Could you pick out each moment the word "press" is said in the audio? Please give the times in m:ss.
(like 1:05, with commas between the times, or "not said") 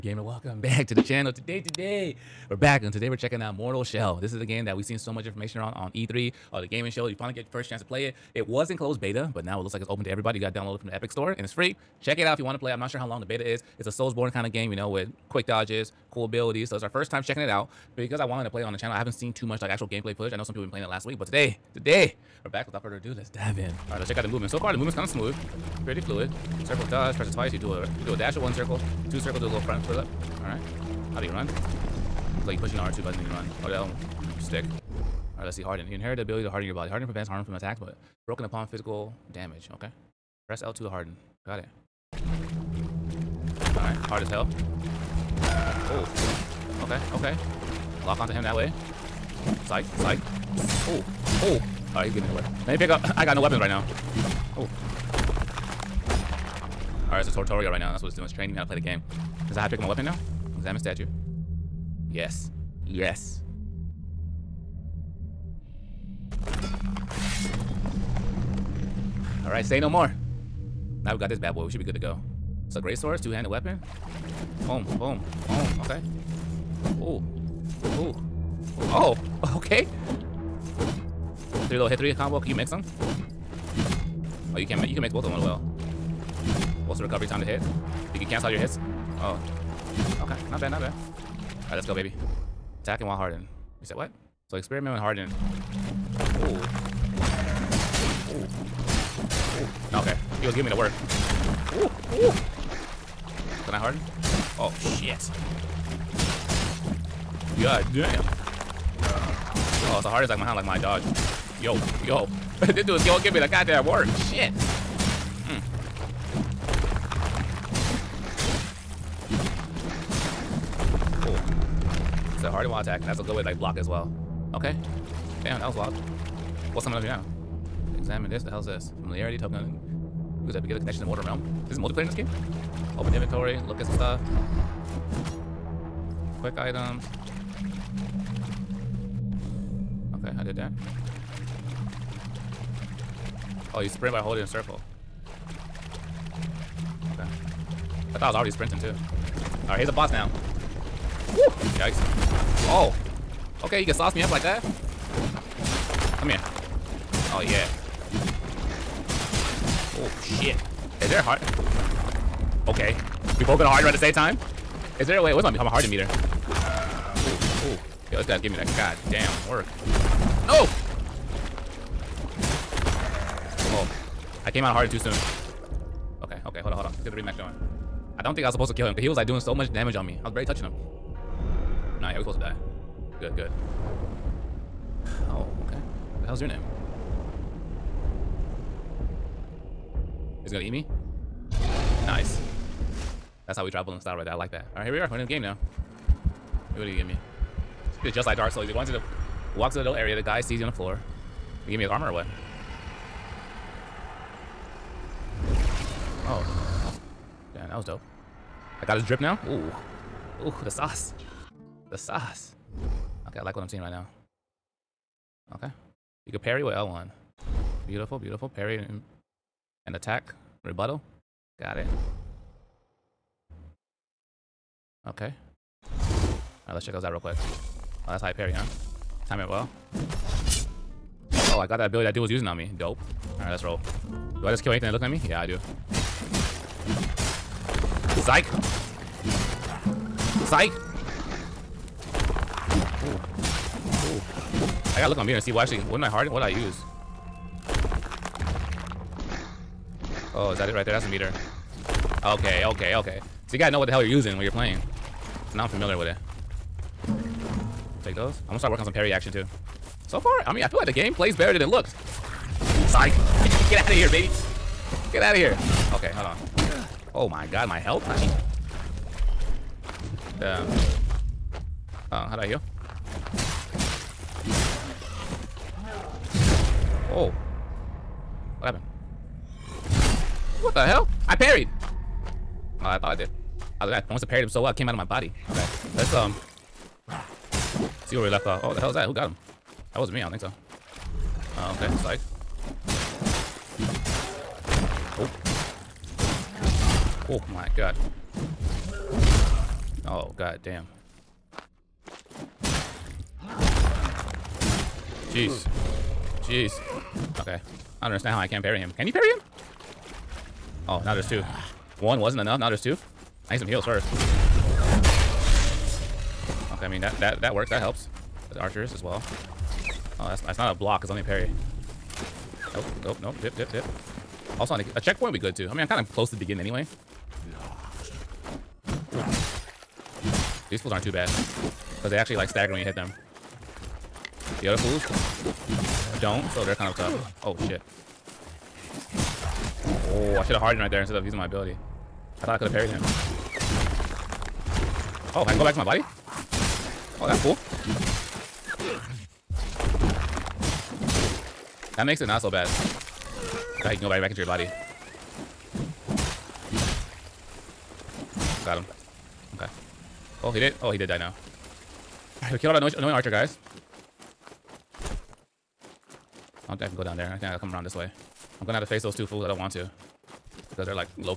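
0:27, 0:40.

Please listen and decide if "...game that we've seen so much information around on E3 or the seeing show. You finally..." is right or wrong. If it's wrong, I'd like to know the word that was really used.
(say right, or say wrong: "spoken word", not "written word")
wrong: "gaming", not "seeing".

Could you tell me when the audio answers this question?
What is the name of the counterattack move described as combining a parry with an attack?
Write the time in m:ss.
3:40.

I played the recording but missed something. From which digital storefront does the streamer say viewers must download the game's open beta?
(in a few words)
Epic Store.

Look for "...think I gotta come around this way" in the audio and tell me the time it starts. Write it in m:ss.
6:07.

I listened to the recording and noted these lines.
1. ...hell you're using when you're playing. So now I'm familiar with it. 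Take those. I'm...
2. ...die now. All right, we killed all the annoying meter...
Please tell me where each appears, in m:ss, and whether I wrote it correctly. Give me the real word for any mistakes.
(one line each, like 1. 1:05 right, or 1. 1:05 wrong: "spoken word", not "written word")
1. 4:13 right
2. 6:01 wrong: "archer", not "meter".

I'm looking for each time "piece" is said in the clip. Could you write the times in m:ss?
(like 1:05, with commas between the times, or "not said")
not said.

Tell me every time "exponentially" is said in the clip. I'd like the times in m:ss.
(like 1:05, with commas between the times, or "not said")
not said.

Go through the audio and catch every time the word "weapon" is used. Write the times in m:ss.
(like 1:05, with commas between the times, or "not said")
0:53, 0:59, 1:13.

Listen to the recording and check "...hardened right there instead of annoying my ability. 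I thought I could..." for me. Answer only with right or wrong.
wrong.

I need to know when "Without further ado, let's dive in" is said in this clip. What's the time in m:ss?
0:22.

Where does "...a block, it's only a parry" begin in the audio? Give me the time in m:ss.
5:20.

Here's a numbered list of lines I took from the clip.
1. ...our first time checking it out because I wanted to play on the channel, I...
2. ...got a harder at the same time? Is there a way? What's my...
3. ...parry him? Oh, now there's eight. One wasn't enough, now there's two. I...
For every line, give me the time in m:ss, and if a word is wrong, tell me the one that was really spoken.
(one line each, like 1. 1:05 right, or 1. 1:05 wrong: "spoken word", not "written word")
1. 0:16 right
2. 2:43 right
3. 5:09 wrong: "two", not "eight".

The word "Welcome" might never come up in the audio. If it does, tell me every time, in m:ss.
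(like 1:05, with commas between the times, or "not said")
0:00.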